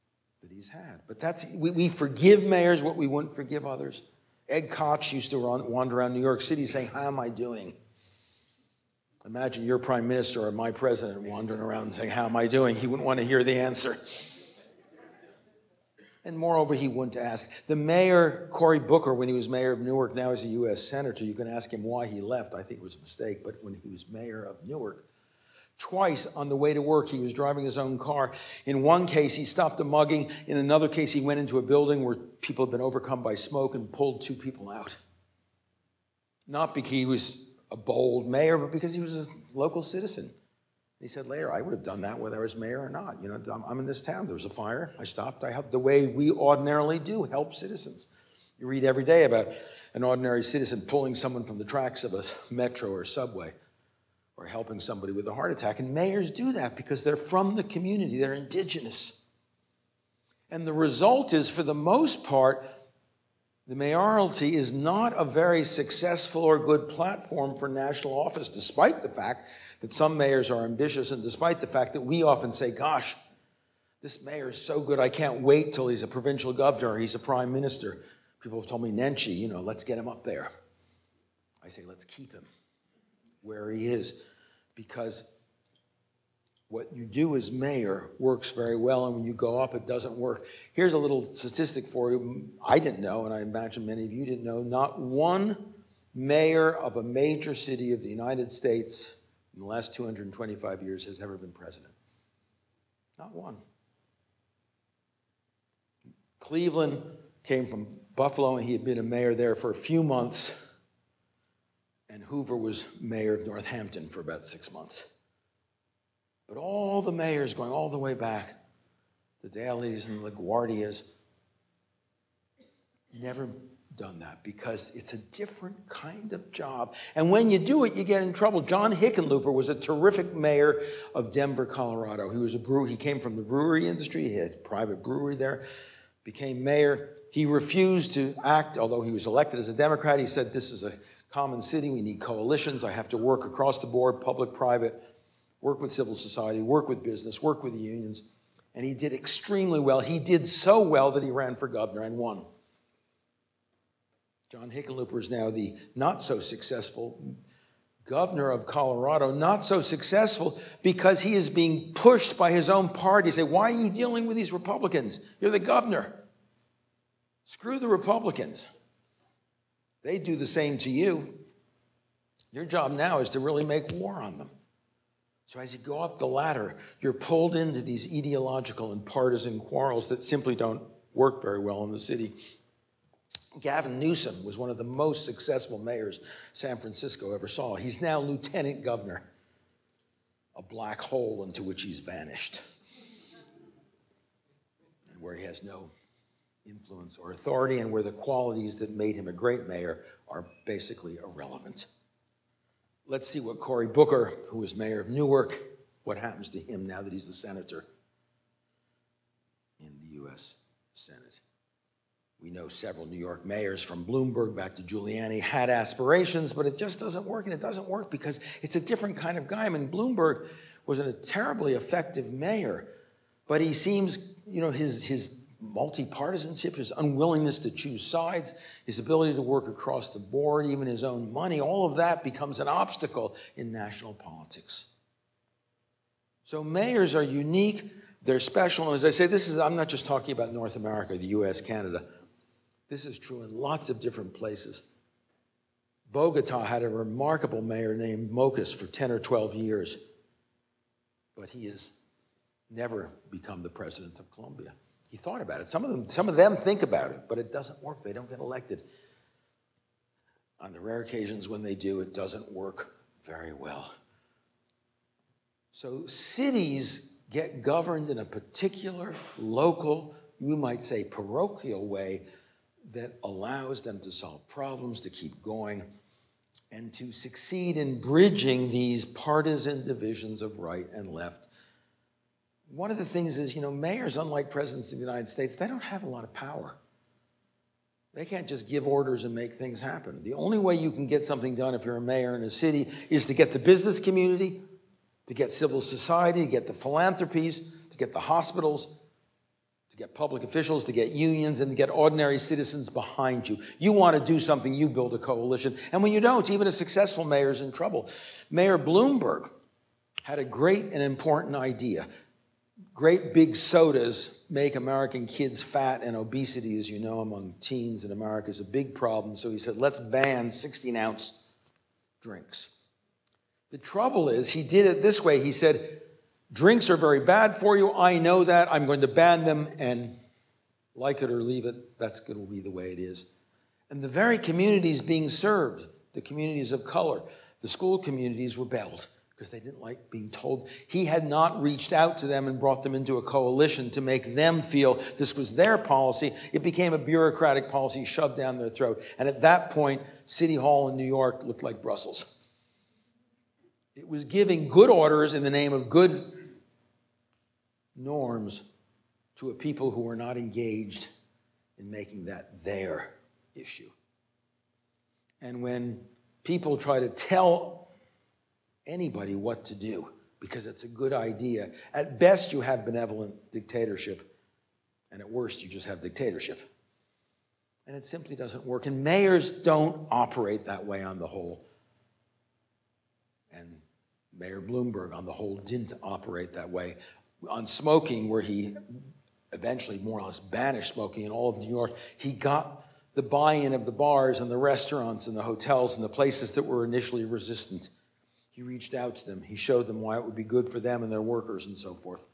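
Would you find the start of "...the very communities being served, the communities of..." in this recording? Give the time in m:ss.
5:34.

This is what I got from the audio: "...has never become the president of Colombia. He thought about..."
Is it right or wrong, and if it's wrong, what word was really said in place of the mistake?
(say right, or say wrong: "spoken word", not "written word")
right.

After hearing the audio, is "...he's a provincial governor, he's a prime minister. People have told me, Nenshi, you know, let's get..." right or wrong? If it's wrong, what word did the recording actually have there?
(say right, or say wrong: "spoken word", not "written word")
right.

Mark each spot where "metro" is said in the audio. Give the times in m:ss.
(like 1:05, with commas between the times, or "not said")
0:52.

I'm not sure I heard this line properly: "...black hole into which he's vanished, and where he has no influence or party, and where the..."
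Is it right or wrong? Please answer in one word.
wrong.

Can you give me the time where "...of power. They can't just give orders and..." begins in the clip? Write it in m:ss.
4:46.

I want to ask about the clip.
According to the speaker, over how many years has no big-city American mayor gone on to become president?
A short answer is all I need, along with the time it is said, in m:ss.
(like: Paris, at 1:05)
225, at 1:39.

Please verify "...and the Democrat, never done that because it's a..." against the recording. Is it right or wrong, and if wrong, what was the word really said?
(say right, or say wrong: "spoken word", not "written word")
wrong: "LaGuardias", not "Democrat".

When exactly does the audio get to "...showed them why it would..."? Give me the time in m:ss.
6:39.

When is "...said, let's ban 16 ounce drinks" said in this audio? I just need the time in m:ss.
5:19.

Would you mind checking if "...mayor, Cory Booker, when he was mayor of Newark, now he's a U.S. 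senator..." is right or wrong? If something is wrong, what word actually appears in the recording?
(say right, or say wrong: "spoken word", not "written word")
right.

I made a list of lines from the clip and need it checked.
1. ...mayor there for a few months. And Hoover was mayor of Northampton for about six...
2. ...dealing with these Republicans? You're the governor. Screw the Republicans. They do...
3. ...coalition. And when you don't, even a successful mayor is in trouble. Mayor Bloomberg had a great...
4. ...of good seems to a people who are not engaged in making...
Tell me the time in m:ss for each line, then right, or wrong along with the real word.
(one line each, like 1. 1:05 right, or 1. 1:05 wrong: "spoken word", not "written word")
1. 1:49 right
2. 2:43 right
3. 5:05 right
4. 5:55 wrong: "norms", not "seems".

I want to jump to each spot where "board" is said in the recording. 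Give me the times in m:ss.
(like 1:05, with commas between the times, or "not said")
2:23, 3:50.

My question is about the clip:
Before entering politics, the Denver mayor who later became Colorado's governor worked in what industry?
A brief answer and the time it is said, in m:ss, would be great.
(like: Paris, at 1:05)
Brewery industry, at 2:13.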